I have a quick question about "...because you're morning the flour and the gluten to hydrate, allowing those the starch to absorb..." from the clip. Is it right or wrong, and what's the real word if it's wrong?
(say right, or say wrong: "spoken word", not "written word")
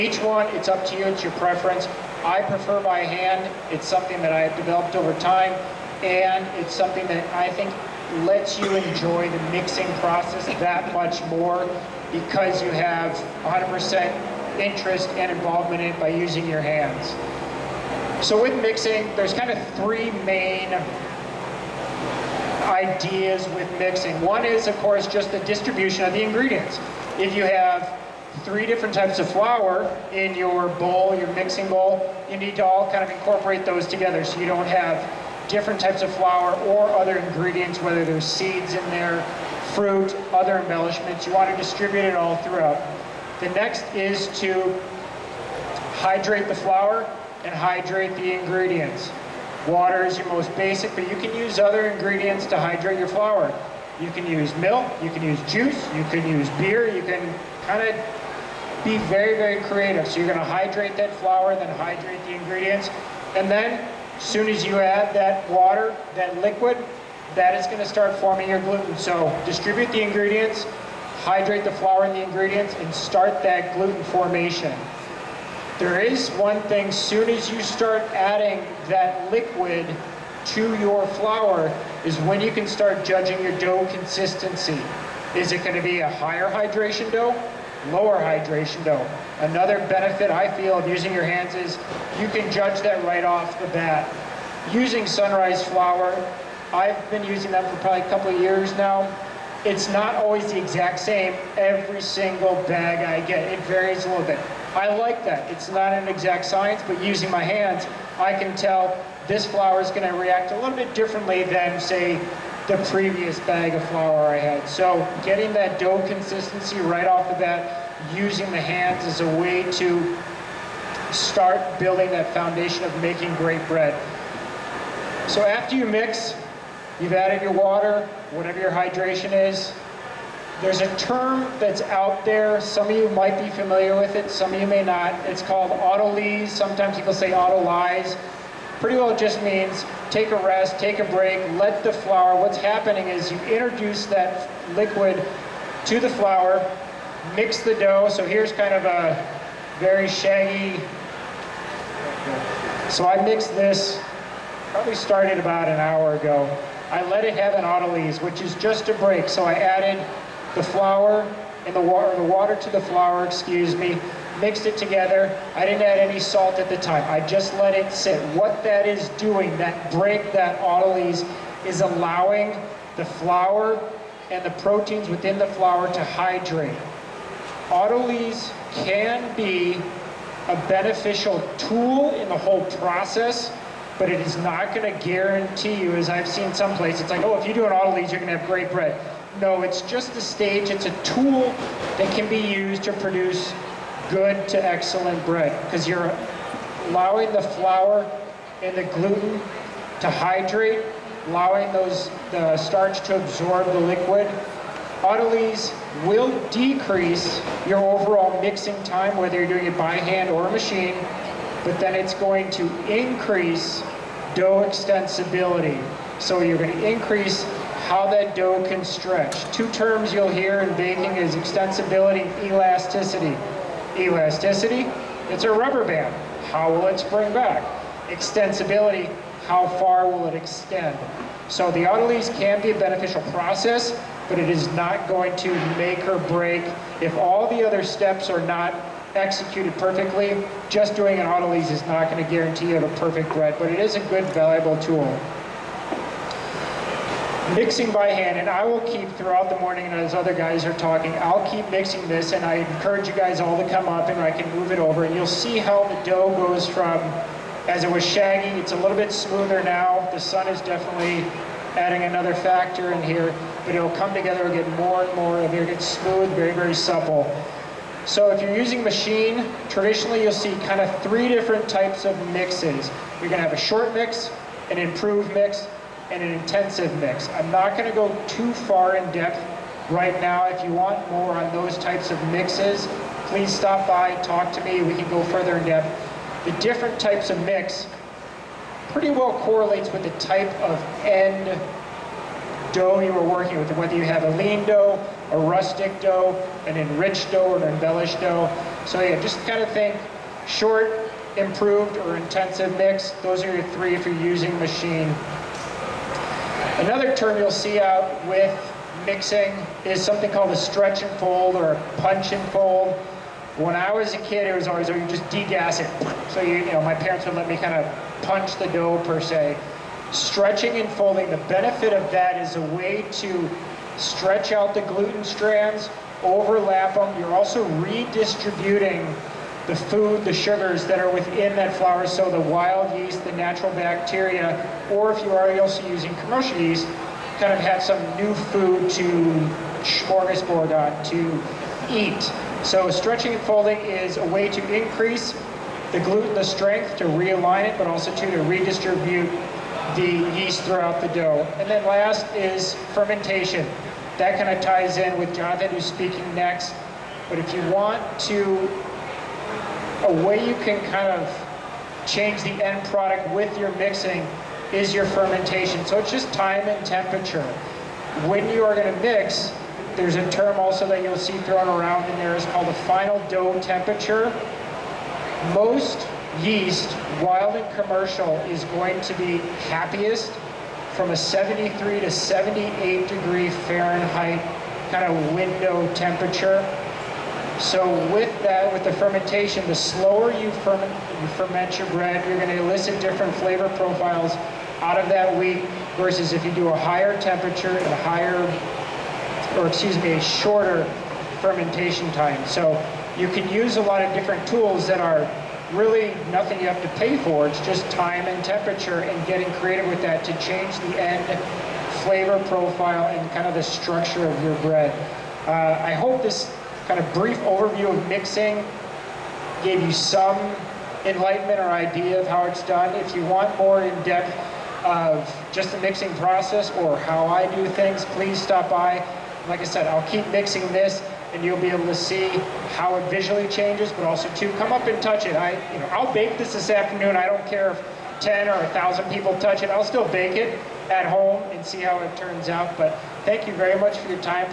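wrong: "allowing", not "morning".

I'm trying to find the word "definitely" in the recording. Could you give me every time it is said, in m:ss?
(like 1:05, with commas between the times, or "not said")
4:20.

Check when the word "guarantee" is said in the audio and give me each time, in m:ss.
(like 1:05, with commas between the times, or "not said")
3:05, 4:02.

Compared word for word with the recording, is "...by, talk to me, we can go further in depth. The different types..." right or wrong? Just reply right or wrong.
right.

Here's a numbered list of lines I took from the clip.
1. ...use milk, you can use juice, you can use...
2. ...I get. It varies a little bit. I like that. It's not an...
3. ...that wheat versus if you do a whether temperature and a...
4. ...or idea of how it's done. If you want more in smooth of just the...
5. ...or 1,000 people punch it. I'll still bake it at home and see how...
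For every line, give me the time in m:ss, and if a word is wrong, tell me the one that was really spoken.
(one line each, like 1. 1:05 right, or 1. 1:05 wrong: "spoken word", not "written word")
1. 0:54 right
2. 1:42 right
3. 6:35 wrong: "higher", not "whether"
4. 7:01 wrong: "depth", not "smooth"
5. 7:18 wrong: "touch", not "punch".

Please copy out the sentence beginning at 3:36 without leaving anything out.
So you're going to increase how that dough can stretch.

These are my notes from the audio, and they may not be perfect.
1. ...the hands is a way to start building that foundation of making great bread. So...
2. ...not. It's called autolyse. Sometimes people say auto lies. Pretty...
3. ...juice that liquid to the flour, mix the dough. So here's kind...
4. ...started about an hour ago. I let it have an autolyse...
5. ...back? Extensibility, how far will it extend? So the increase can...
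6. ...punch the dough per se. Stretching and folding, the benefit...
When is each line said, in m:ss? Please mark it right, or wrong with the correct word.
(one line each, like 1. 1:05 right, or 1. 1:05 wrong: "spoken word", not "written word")
1. 1:58 right
2. 2:14 right
3. 2:23 wrong: "introduce", not "juice"
4. 2:34 right
5. 3:47 wrong: "autolyse", not "increase"
6. 5:18 right.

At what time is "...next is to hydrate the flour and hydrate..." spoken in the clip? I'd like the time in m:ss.
0:43.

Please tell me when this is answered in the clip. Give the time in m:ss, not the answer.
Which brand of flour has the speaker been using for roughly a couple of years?
1:35.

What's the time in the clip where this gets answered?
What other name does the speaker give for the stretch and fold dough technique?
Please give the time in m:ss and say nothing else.
5:11.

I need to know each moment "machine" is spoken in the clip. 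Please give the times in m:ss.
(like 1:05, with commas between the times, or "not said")
3:30, 4:28, 5:04.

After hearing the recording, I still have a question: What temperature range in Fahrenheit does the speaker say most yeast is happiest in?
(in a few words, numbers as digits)
73 to 78 degrees.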